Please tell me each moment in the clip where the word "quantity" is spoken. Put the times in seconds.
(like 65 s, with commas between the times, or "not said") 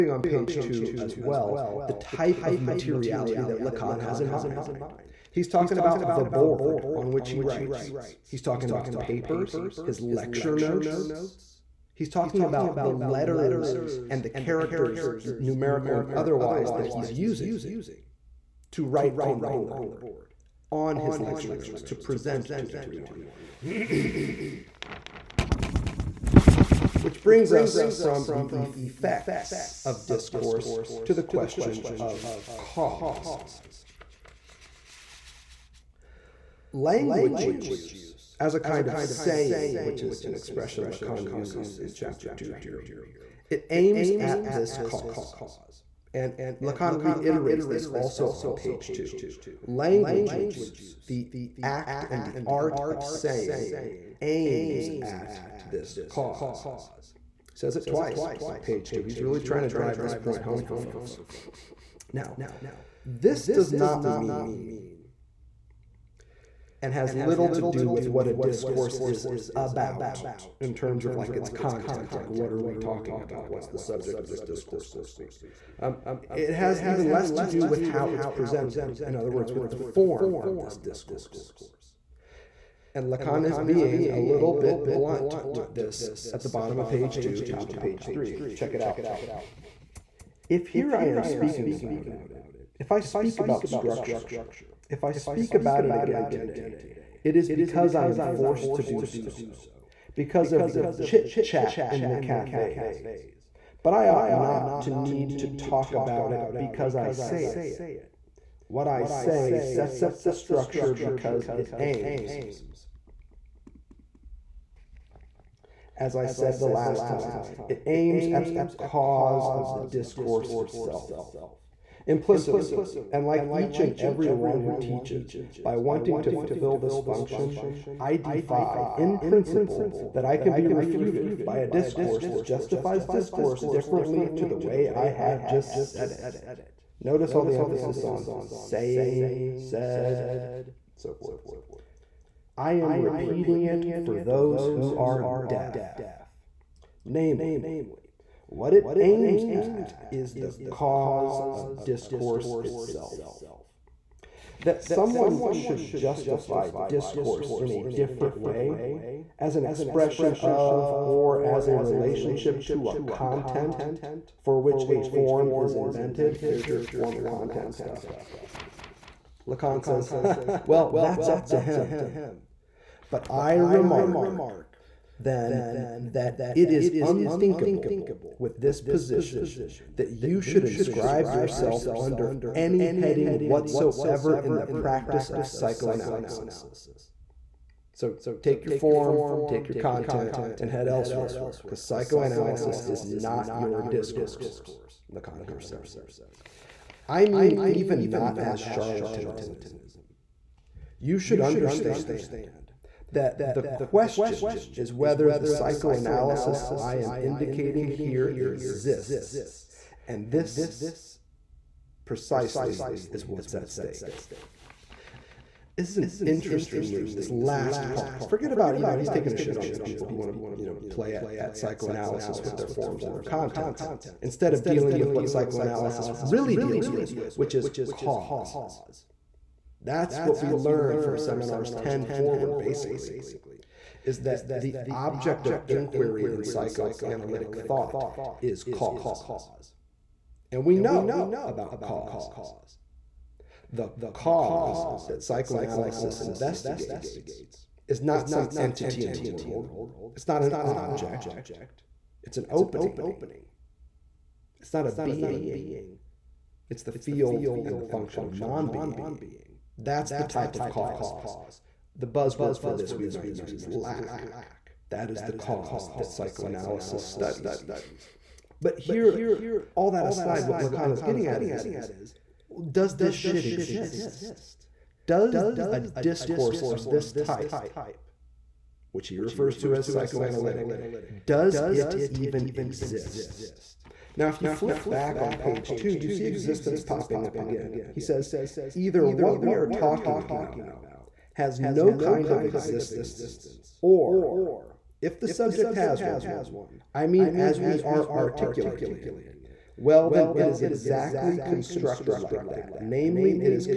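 not said.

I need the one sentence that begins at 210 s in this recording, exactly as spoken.
And this precisely is what's at stake.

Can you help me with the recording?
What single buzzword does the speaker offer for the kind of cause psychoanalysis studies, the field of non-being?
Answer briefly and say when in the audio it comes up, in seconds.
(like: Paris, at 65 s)
lack, at 263 s.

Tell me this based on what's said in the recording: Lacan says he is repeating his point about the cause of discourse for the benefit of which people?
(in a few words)
those who are deaf.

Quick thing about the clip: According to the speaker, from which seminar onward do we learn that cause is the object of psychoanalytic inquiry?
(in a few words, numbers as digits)
10.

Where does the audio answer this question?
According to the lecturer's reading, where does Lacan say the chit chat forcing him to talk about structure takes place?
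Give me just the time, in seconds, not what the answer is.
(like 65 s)
101 s.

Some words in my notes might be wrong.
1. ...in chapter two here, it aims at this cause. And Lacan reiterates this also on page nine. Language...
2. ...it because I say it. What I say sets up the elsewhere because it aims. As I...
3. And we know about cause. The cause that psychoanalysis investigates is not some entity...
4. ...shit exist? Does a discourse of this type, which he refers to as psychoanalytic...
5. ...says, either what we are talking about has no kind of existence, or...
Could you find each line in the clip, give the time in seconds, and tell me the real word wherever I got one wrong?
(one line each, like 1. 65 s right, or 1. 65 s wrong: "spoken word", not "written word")
1. 41 s wrong: "two", not "nine"
2. 106 s wrong: "structure", not "elsewhere"
3. 240 s right
4. 273 s right
5. 287 s right.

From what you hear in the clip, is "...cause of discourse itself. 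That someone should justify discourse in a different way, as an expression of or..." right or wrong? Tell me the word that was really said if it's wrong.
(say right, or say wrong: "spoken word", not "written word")
right.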